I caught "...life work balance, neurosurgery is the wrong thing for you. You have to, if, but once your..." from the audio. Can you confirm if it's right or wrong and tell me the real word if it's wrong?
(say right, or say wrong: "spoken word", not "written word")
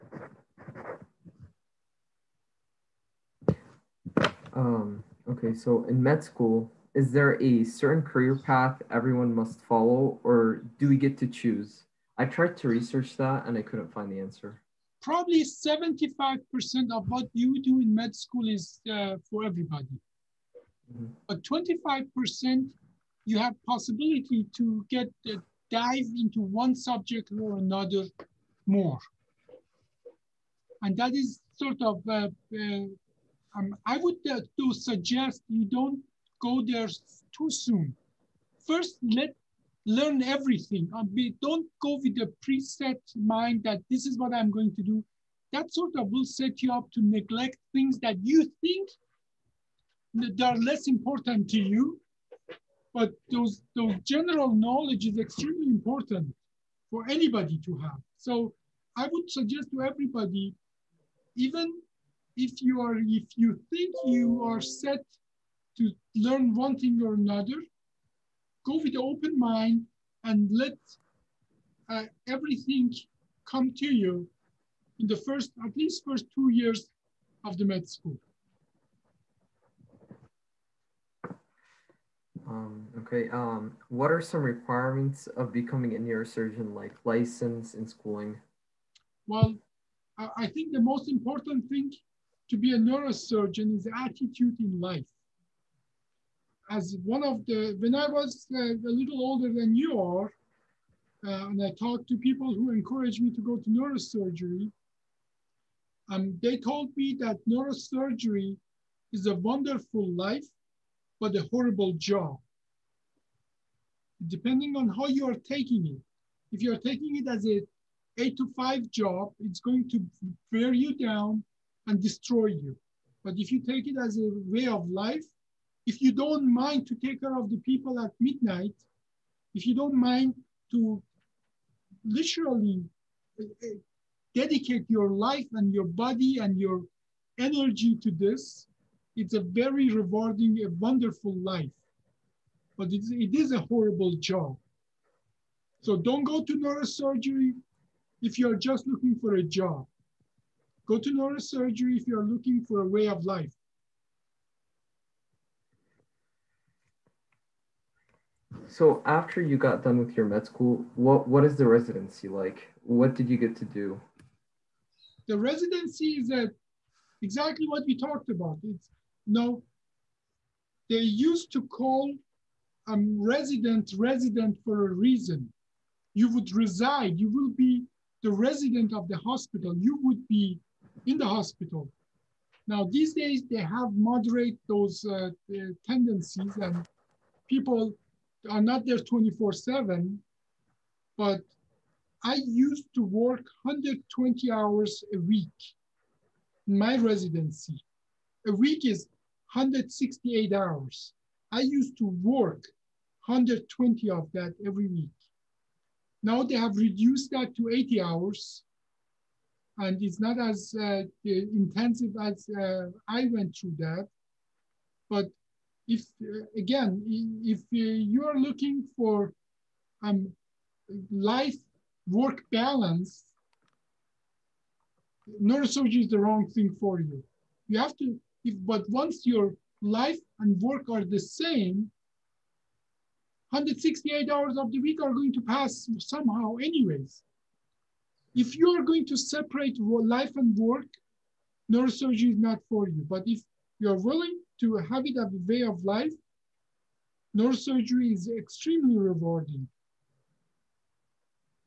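right.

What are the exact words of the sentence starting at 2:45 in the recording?
The residency is that exactly what we talked about.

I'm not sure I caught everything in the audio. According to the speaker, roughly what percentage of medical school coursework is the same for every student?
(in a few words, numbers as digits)
75%.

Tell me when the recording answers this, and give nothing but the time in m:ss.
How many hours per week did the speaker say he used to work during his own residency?
3:13.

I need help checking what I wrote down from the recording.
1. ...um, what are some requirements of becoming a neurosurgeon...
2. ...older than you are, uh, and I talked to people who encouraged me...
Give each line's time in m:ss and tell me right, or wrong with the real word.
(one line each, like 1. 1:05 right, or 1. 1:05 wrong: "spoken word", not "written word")
1. 1:23 right
2. 1:39 right.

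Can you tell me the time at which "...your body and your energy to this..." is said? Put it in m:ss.
2:15.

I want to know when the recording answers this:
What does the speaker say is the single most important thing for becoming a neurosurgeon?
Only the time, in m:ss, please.
1:34.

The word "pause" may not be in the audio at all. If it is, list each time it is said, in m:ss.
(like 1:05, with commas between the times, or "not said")
not said.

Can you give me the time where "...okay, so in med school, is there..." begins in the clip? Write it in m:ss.
0:05.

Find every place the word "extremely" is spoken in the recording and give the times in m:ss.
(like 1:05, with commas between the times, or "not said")
0:55, 4:08.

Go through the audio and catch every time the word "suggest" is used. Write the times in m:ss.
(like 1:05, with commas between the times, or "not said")
0:34, 0:59.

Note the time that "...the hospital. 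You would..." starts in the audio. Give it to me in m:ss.
2:59.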